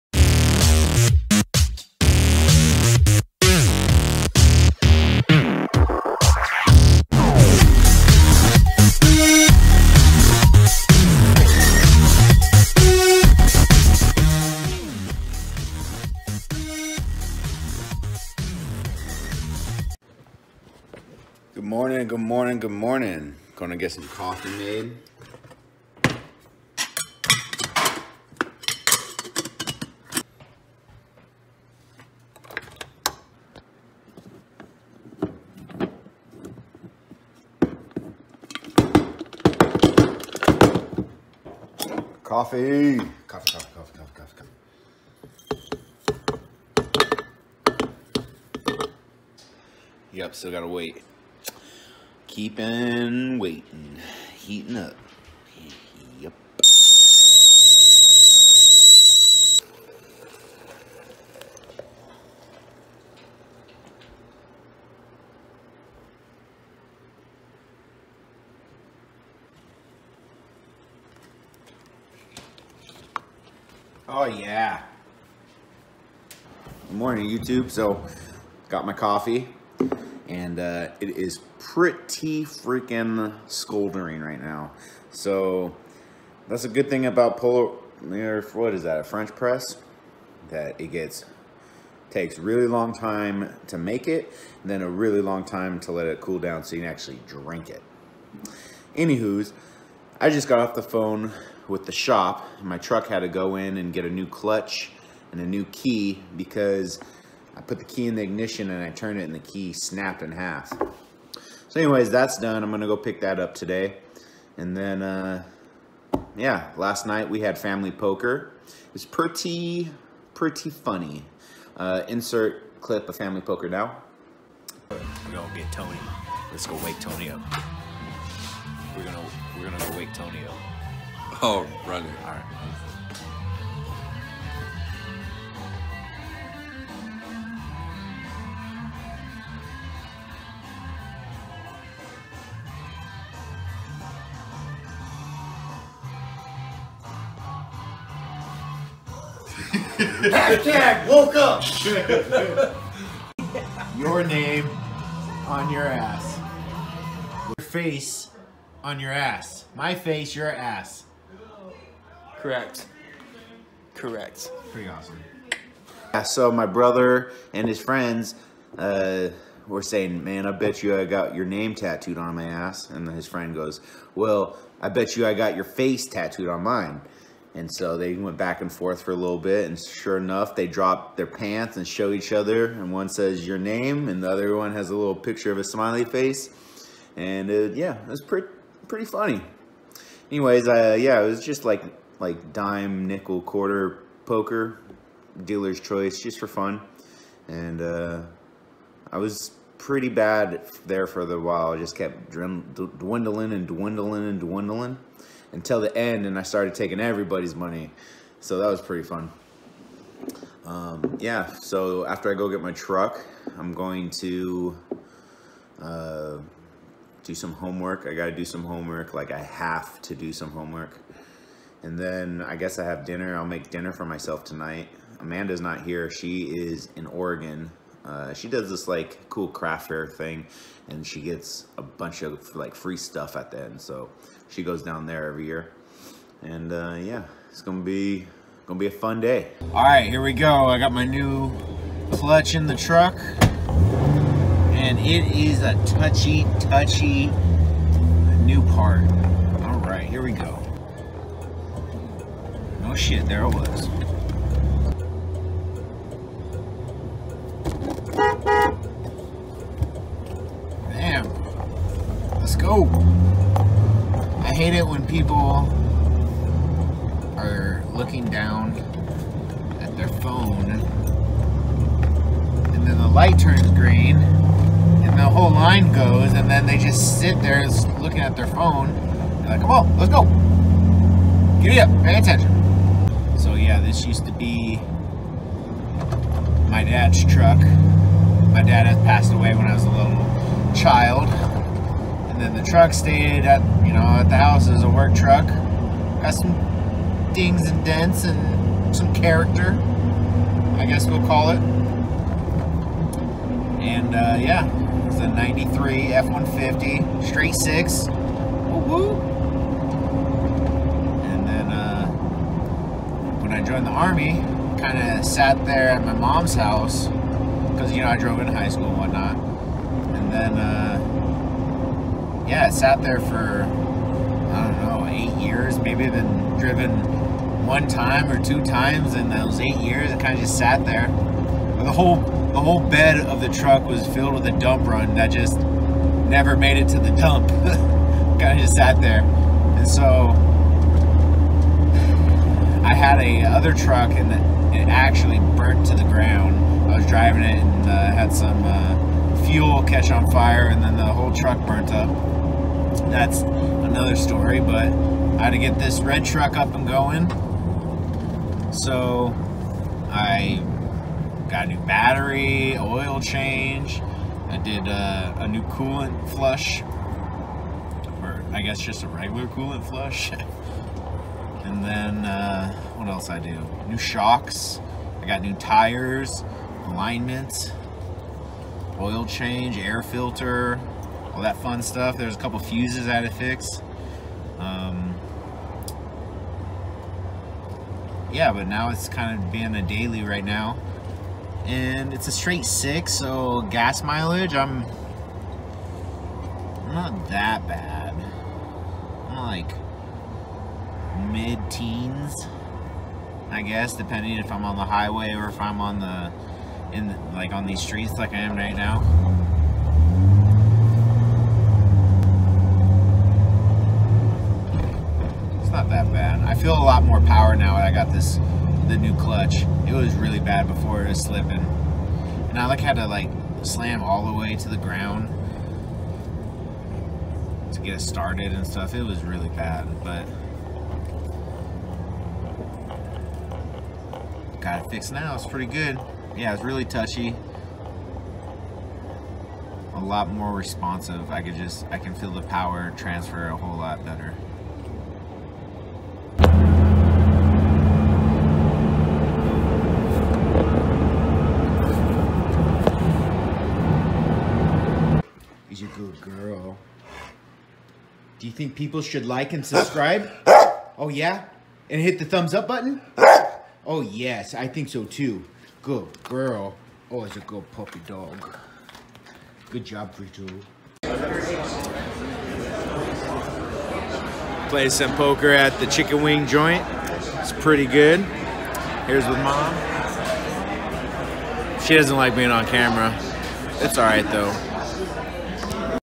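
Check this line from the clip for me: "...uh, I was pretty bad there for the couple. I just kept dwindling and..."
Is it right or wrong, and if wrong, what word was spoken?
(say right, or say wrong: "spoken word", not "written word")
wrong: "while", not "couple".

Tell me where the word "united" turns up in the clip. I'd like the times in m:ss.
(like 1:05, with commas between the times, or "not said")
not said.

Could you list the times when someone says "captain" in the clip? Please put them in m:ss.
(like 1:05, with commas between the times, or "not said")
not said.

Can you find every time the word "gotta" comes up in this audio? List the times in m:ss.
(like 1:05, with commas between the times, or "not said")
0:50, 3:38.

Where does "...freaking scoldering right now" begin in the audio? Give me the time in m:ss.
1:22.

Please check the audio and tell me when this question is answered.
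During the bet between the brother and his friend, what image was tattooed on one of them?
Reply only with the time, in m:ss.
3:05.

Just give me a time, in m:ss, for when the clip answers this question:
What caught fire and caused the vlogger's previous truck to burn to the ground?
5:49.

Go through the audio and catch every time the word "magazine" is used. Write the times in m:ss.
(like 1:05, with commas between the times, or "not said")
not said.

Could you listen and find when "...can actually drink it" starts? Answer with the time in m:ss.
1:36.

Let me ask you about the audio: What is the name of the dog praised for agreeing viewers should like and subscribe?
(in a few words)
Frito.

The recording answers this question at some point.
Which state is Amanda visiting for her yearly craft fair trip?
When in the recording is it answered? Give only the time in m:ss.
3:47.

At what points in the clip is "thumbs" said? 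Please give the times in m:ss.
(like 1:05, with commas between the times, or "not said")
7:42.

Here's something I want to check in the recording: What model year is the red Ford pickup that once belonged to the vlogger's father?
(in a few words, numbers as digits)
1993.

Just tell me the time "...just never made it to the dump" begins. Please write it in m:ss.
5:35.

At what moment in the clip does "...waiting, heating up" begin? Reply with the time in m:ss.
0:53.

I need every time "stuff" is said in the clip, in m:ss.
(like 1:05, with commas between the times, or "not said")
3:52, 6:21, 7:08.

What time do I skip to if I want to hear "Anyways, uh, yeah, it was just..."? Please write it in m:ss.
3:10.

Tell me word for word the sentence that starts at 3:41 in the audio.
And then I guess I have dinner.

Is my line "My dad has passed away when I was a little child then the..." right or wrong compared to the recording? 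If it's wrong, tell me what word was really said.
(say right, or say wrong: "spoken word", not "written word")
right.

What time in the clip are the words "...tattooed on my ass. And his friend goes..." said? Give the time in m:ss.
2:51.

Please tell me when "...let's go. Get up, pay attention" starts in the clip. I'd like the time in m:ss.
4:39.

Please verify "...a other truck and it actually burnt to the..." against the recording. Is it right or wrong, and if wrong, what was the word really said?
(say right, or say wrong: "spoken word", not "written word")
right.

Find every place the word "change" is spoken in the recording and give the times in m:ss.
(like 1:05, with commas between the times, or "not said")
6:03, 6:19.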